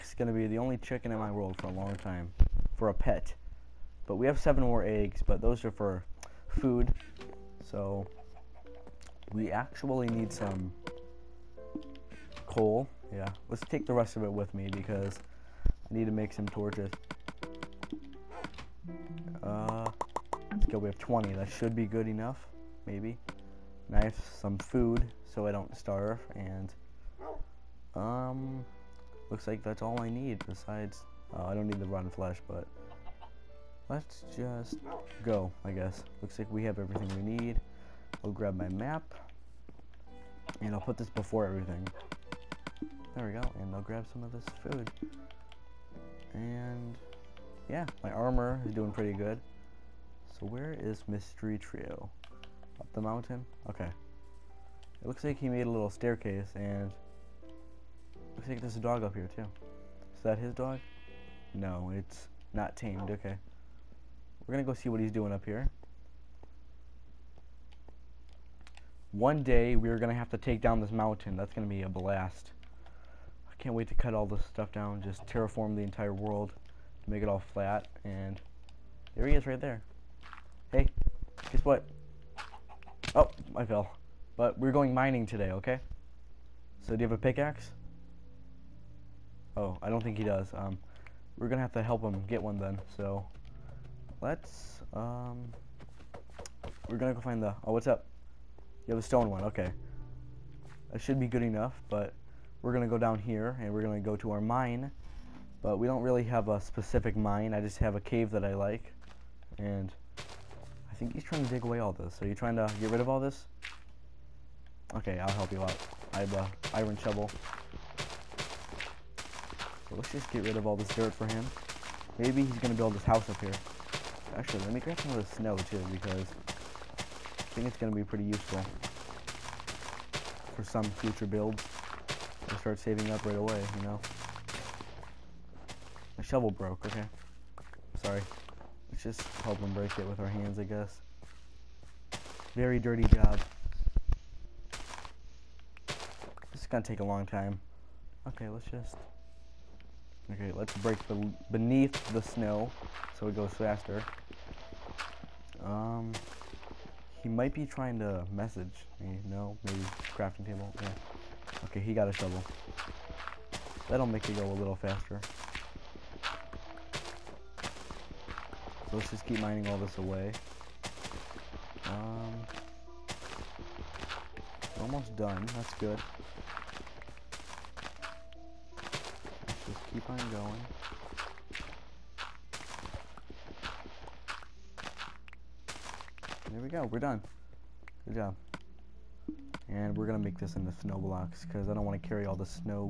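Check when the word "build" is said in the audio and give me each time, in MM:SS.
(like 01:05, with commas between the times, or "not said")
02:02, 02:11.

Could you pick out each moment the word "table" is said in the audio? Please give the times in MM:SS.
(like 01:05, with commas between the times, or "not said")
02:40.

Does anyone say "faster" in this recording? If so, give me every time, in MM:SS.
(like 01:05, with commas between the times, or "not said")
02:33, 02:44.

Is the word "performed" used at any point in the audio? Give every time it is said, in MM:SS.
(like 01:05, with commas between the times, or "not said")
not said.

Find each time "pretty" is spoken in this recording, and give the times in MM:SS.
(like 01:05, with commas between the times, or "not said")
00:48, 02:08.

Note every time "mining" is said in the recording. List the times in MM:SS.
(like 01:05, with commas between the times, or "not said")
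01:24, 02:49.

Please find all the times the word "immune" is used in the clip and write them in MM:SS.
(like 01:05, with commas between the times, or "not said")
not said.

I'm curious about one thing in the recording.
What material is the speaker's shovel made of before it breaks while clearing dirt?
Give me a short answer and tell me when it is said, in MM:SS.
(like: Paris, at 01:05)
Iron, at 01:56.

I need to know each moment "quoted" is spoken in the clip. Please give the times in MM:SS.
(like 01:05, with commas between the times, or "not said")
not said.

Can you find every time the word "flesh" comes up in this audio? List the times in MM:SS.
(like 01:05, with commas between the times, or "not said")
00:32.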